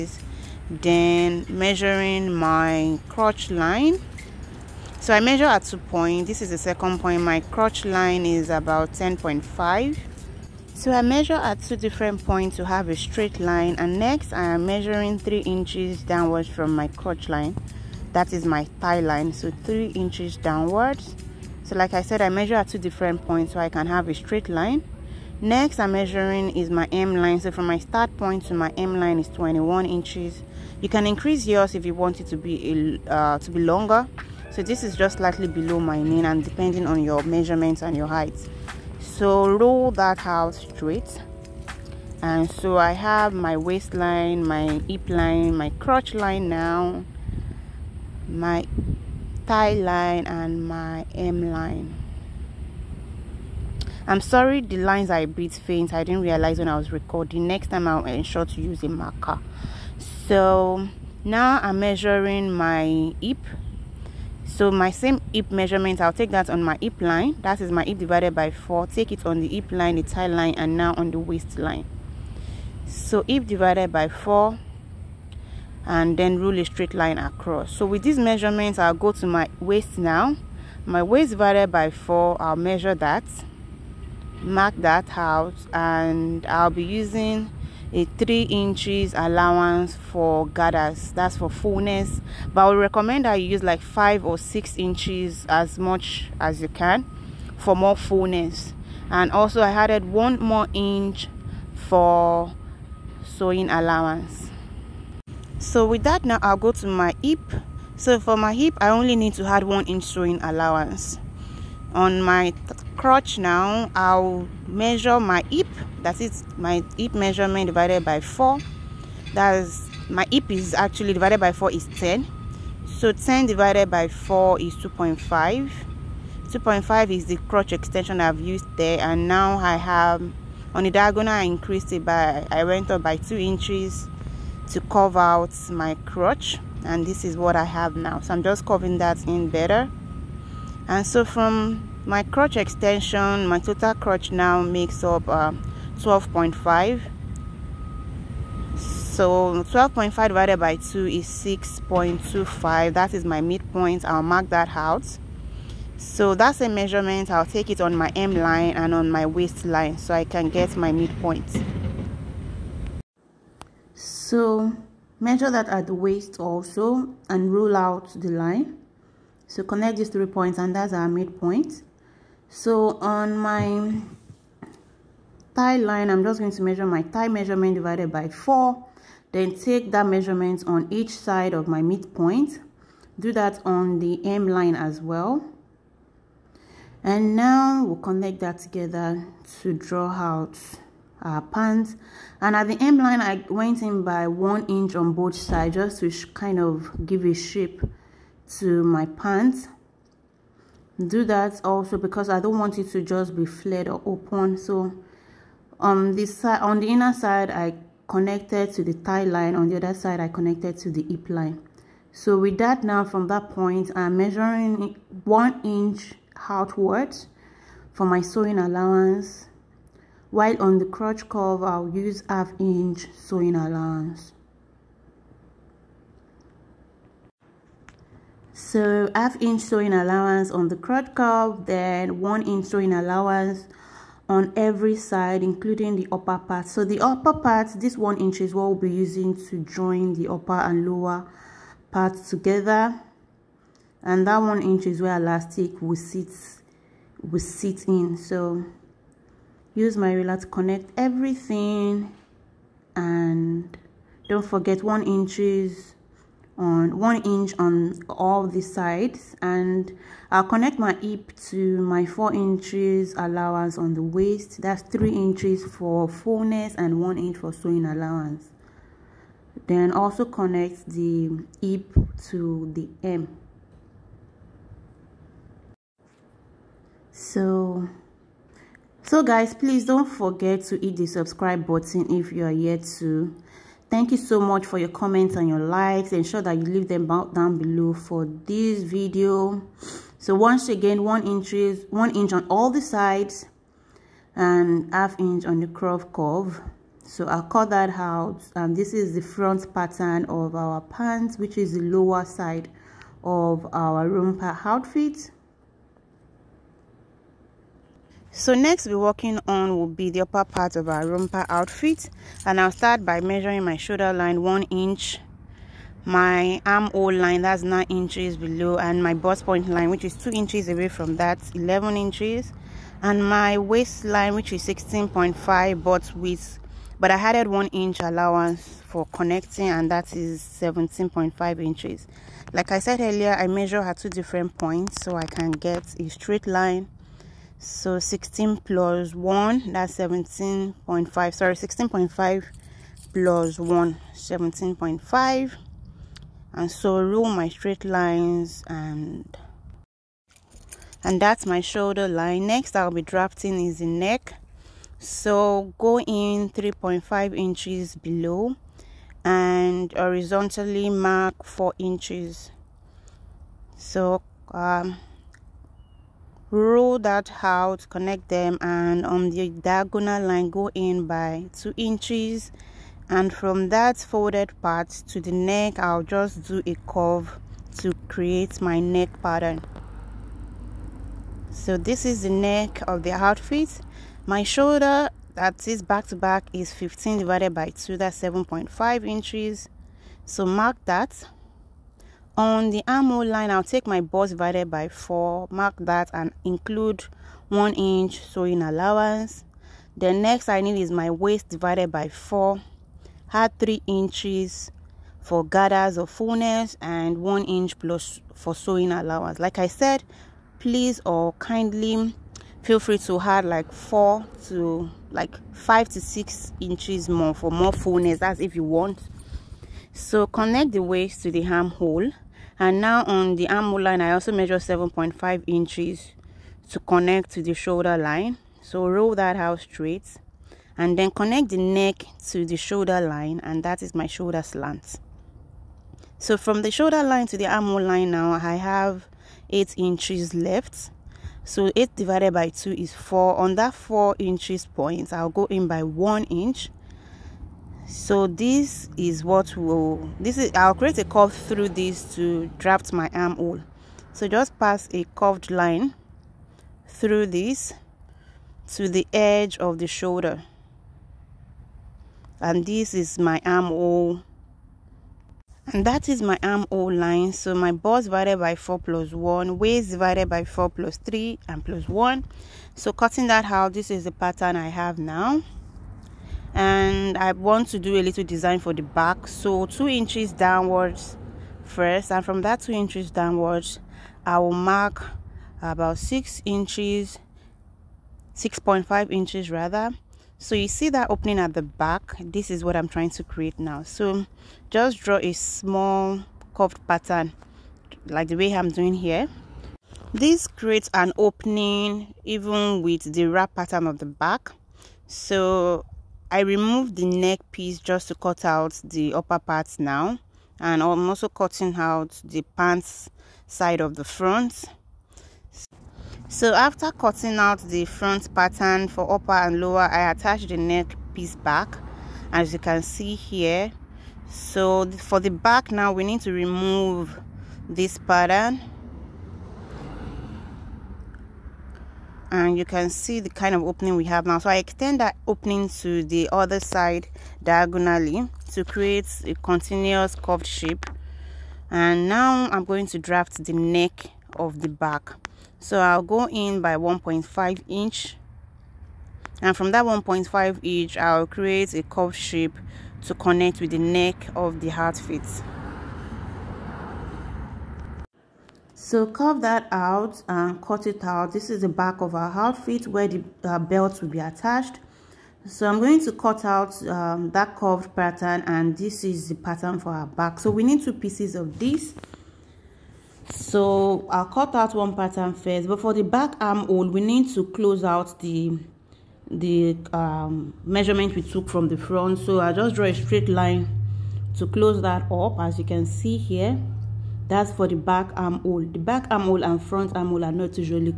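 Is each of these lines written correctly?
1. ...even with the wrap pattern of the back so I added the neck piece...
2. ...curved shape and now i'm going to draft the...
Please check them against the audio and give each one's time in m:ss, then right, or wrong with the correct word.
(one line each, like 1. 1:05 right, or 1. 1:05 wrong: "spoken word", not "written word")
1. 8:22 wrong: "removed", not "added"
2. 9:00 right.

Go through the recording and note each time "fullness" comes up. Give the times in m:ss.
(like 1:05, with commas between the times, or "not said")
1:31, 1:37, 4:26, 6:46, 6:57.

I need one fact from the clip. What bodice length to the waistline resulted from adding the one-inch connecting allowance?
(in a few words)
17.5 inches.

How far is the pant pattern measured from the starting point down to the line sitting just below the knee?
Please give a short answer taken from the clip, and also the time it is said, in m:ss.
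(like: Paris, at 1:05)
21 inches, at 0:29.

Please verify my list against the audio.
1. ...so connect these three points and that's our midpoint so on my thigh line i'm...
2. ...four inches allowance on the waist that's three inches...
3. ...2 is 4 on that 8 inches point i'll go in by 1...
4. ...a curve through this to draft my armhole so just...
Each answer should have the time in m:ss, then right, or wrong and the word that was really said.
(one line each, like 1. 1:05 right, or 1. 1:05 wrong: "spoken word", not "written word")
1. 2:49 right
2. 4:22 right
3. 7:22 wrong: "4", not "8"
4. 7:30 right.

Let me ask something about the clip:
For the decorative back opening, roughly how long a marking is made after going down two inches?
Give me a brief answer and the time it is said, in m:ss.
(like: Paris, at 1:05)
6.5 inches, at 8:08.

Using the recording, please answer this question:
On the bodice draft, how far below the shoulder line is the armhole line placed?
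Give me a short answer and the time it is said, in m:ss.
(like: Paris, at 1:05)
9 inches, at 5:17.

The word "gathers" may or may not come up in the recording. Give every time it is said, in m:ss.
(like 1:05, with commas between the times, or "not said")
1:30, 6:45.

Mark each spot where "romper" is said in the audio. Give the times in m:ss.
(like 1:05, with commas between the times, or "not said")
5:04, 5:11.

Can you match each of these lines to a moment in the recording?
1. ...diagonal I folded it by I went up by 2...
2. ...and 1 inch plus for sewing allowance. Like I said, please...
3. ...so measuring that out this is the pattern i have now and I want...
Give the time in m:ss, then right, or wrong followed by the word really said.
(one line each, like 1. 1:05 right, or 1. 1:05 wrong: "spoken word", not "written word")
1. 2:10 wrong: "increased", not "folded"
2. 6:46 right
3. 7:52 wrong: "cutting", not "measuring".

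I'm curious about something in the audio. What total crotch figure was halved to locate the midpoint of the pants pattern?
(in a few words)
12.5.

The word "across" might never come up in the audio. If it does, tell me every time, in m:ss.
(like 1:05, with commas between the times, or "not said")
1:17.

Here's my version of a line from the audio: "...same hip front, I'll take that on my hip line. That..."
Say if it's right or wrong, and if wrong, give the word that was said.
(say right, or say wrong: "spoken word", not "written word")
wrong: "measurement", not "front".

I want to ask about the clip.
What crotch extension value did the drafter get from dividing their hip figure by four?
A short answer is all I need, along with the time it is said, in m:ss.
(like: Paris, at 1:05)
2.5, at 2:06.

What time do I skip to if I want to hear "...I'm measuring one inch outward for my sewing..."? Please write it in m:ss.
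3:33.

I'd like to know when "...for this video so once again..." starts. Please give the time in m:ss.
4:47.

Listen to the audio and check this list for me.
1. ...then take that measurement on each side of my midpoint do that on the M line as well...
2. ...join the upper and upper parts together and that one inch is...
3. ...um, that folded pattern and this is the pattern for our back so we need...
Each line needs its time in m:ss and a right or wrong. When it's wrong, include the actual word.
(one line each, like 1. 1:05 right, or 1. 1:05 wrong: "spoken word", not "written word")
1. 2:59 right
2. 3:59 wrong: "lower", not "upper"
3. 9:26 wrong: "curved", not "folded".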